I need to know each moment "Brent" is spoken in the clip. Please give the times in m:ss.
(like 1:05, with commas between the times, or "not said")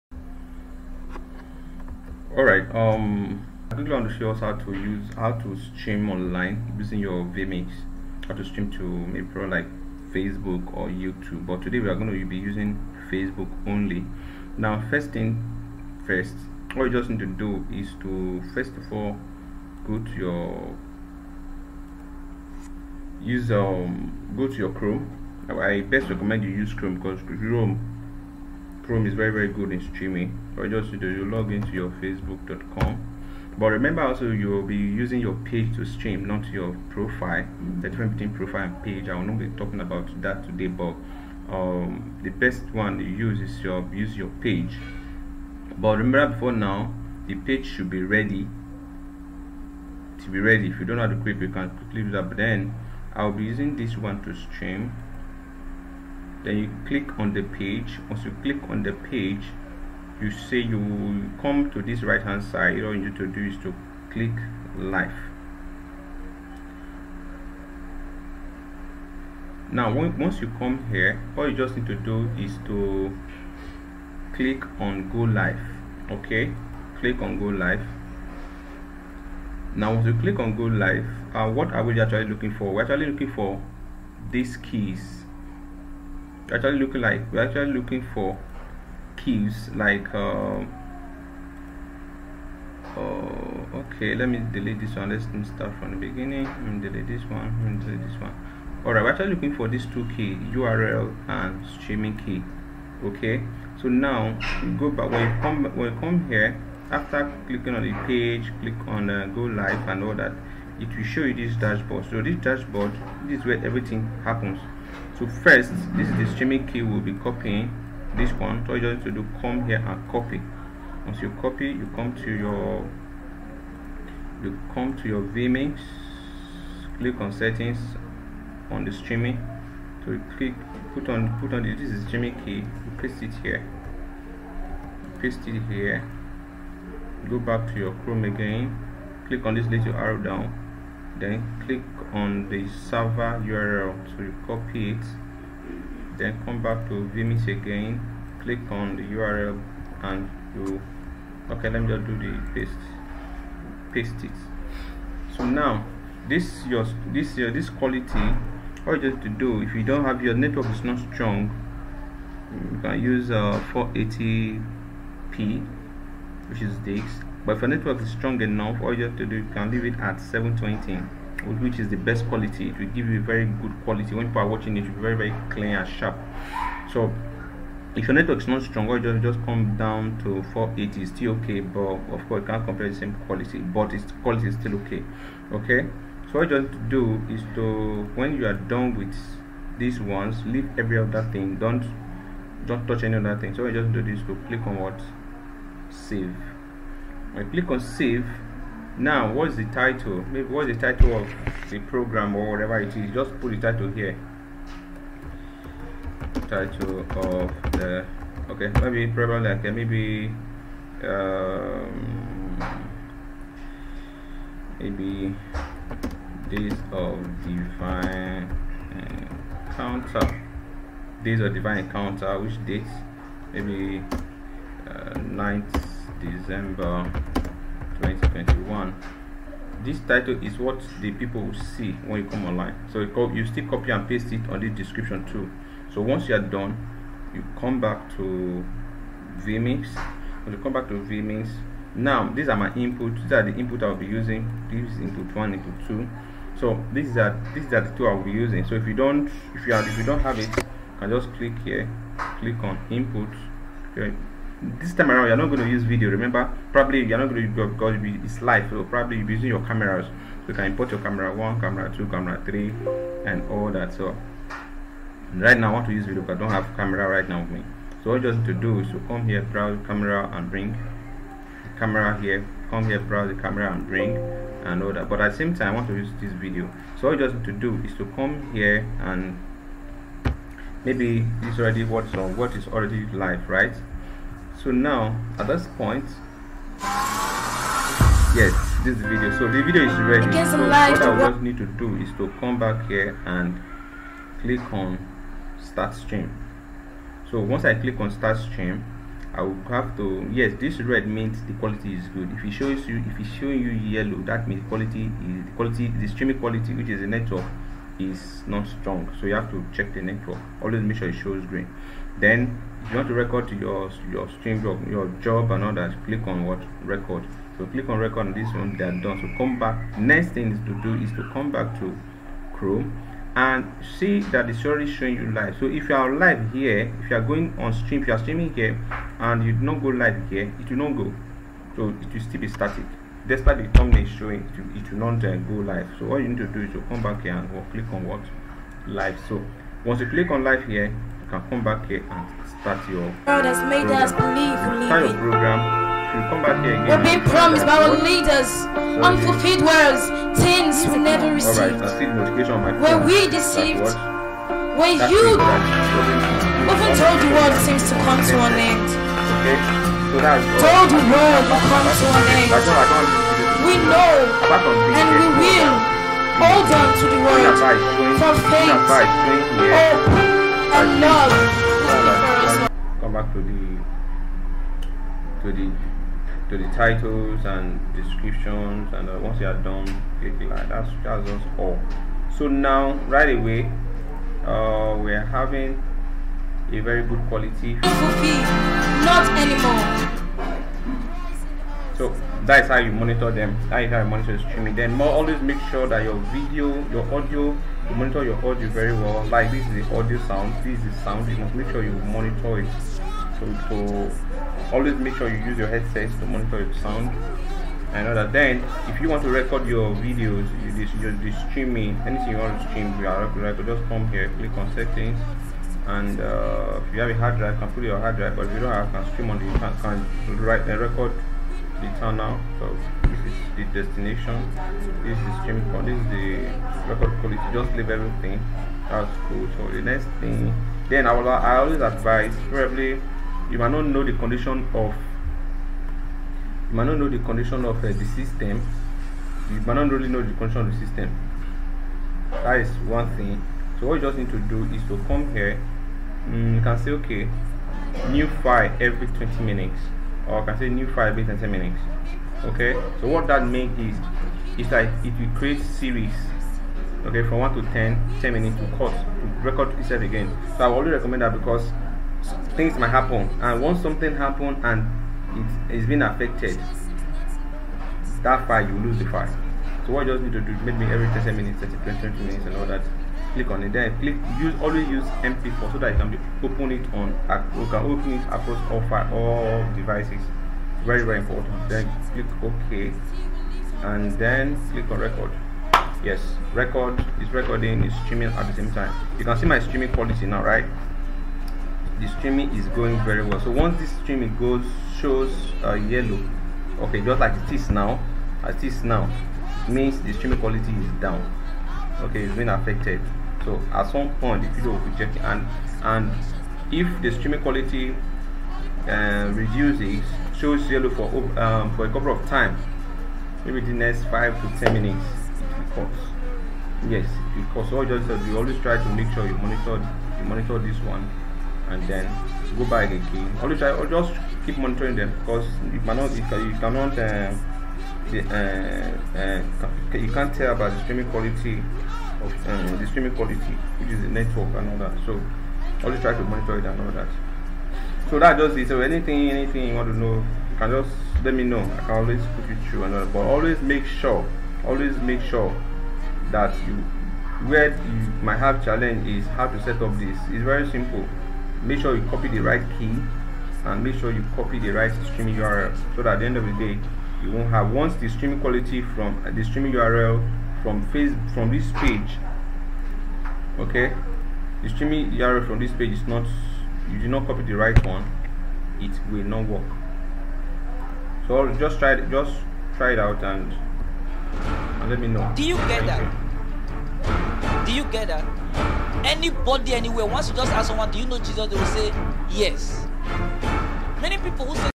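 not said.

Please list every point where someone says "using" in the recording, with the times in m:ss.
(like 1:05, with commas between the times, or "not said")
0:06, 0:12, 0:34, 0:53, 4:04, 4:08, 4:19.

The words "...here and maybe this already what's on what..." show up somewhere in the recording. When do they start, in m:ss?
4:38.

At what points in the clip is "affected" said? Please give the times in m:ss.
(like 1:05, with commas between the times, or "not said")
7:46, 8:22.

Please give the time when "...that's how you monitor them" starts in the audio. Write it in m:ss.
6:32.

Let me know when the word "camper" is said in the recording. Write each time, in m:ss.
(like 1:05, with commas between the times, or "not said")
not said.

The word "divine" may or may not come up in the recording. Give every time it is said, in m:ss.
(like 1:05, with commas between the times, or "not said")
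3:37, 3:41.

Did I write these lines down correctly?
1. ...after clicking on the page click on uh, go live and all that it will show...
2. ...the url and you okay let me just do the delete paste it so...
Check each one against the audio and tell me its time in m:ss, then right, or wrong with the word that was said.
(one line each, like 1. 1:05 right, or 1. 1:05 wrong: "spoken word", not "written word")
1. 1:46 right
2. 2:28 wrong: "paste", not "delete".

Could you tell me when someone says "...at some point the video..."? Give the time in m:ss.
8:23.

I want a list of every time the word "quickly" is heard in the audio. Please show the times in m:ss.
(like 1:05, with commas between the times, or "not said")
0:03, 0:51.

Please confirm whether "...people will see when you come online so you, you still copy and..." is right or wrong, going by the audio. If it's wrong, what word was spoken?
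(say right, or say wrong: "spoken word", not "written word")
right.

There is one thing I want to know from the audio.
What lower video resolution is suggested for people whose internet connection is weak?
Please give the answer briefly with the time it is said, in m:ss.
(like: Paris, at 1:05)
480p, at 2:43.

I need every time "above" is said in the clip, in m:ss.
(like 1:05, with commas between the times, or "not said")
not said.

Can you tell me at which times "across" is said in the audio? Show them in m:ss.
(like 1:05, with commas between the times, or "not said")
7:58.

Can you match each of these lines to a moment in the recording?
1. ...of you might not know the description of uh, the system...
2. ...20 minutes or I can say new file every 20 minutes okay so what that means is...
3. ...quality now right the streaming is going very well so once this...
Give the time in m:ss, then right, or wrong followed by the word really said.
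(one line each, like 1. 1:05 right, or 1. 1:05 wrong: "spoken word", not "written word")
1. 7:14 wrong: "condition", not "description"
2. 7:29 right
3. 8:09 right.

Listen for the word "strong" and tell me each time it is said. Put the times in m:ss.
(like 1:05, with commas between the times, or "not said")
2:41, 2:48, 2:58, 5:08.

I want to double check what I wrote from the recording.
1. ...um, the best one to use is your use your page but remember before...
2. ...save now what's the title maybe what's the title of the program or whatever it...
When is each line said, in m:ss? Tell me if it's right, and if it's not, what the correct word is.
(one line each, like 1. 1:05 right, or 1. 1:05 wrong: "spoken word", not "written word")
1. 0:41 right
2. 3:17 right.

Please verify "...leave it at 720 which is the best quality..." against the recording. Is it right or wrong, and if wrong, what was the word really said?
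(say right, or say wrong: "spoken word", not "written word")
right.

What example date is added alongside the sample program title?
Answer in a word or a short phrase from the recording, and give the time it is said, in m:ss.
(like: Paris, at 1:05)
9 December 2021, at 3:45.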